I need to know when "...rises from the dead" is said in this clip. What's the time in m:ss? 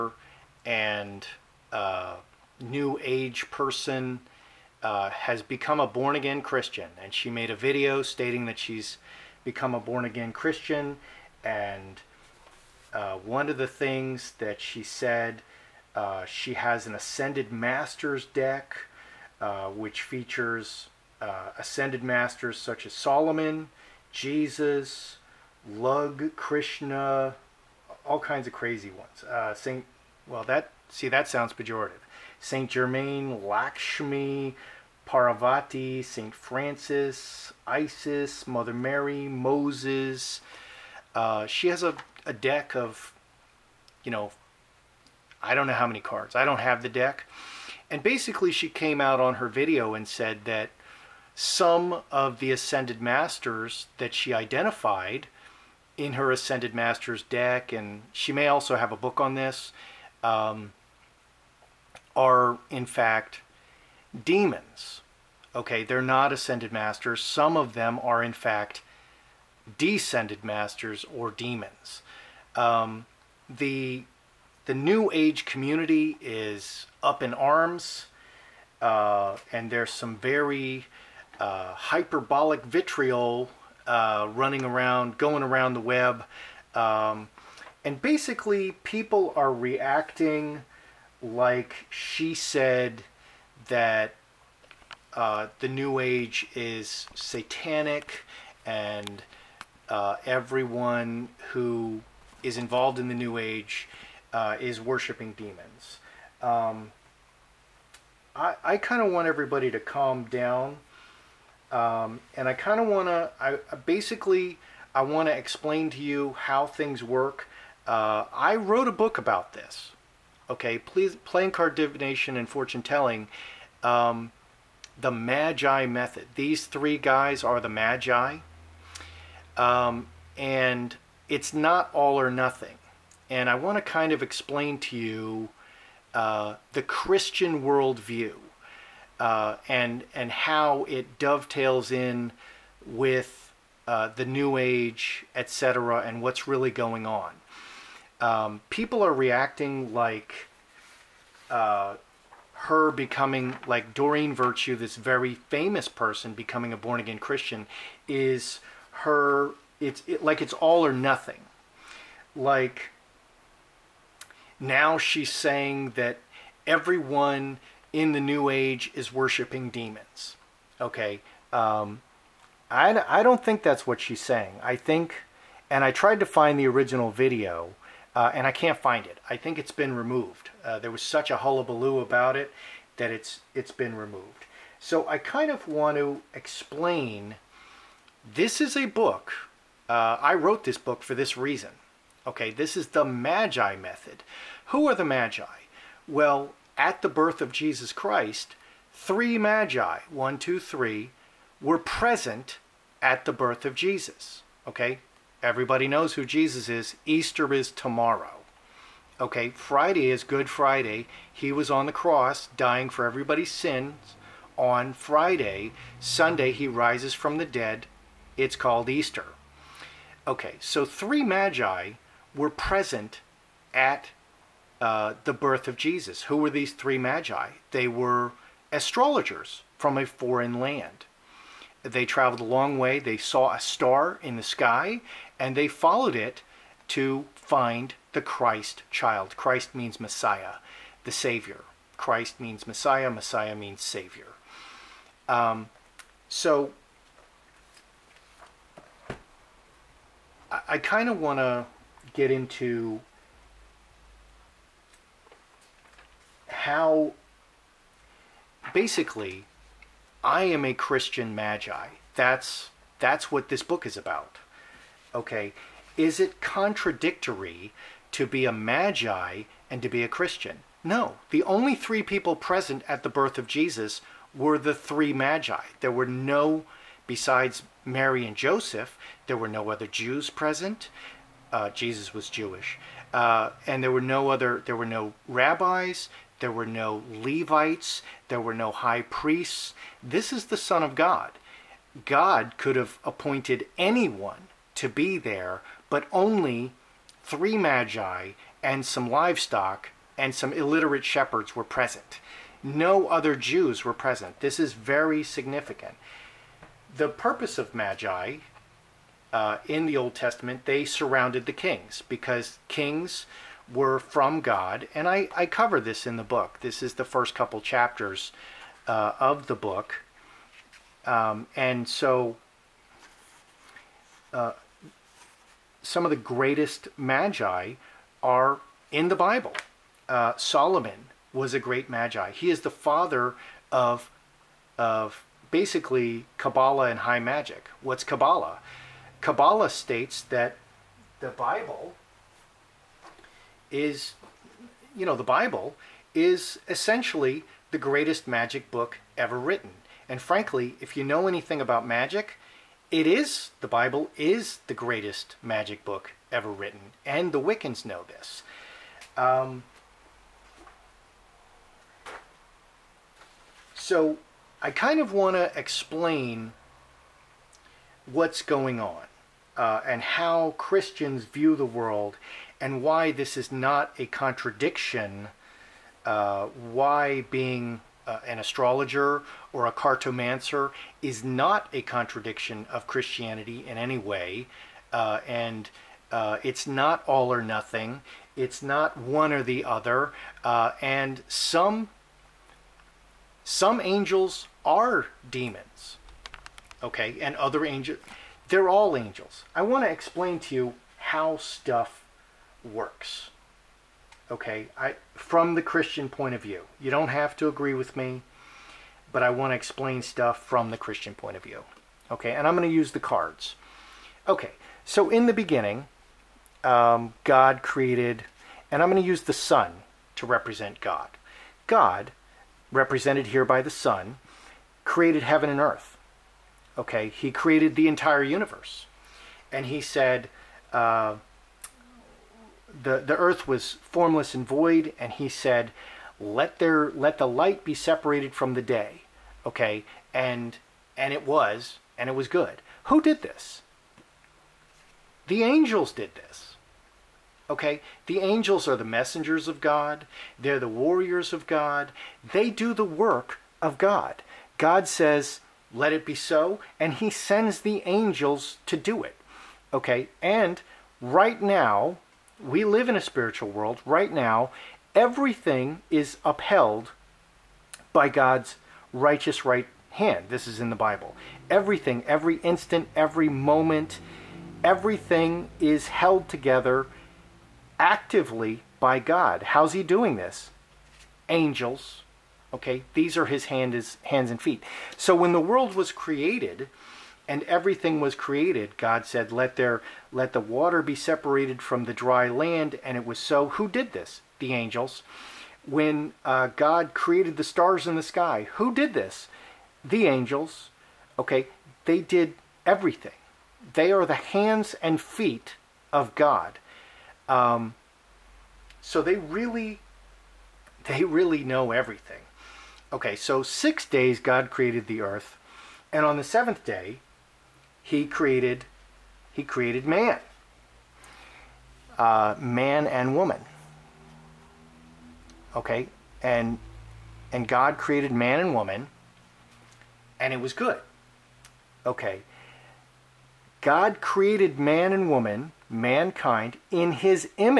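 3:36.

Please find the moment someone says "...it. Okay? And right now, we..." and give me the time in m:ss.
7:39.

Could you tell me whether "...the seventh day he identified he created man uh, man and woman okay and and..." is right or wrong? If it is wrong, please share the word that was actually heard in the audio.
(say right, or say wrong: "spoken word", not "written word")
wrong: "created", not "identified".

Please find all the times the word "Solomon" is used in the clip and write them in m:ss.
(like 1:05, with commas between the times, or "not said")
0:22, 5:30.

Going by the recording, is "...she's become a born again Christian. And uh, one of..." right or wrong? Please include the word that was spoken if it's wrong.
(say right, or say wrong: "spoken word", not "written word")
right.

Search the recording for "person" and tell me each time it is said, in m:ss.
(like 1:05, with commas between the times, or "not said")
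0:03, 2:35.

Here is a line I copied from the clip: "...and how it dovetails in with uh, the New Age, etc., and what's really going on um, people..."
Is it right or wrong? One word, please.
right.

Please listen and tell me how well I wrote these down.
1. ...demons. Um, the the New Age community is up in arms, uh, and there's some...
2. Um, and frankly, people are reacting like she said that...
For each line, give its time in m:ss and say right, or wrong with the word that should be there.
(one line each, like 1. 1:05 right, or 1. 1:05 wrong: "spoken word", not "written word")
1. 1:11 right
2. 1:26 wrong: "basically", not "frankly".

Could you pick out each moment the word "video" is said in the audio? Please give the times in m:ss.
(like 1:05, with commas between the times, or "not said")
0:07, 0:49, 2:57.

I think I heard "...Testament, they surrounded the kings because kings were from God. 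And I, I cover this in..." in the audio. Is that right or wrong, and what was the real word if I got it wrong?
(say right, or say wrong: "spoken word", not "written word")
right.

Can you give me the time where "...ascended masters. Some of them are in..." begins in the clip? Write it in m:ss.
1:06.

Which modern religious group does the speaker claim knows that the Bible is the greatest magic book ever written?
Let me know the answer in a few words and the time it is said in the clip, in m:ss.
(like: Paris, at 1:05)
the Wiccans, at 5:57.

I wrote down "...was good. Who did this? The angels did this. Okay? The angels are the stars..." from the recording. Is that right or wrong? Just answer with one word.
wrong.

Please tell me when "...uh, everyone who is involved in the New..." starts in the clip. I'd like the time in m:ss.
1:39.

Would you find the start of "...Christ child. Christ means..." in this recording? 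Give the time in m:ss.
3:58.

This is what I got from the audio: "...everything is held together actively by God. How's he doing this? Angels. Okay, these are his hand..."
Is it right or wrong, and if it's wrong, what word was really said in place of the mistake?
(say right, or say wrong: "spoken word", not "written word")
right.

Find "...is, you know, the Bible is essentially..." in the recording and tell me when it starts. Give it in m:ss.
5:43.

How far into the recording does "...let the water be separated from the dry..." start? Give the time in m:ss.
8:10.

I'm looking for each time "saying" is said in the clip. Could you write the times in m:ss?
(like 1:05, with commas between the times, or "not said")
2:45, 2:54.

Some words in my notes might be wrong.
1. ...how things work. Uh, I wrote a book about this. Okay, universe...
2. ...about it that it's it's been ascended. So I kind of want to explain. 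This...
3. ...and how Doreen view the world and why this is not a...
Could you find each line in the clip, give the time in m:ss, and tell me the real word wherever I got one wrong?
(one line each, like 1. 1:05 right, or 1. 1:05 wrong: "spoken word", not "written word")
1. 1:56 wrong: "please", not "universe"
2. 3:01 wrong: "removed", not "ascended"
3. 6:09 wrong: "Christians", not "Doreen".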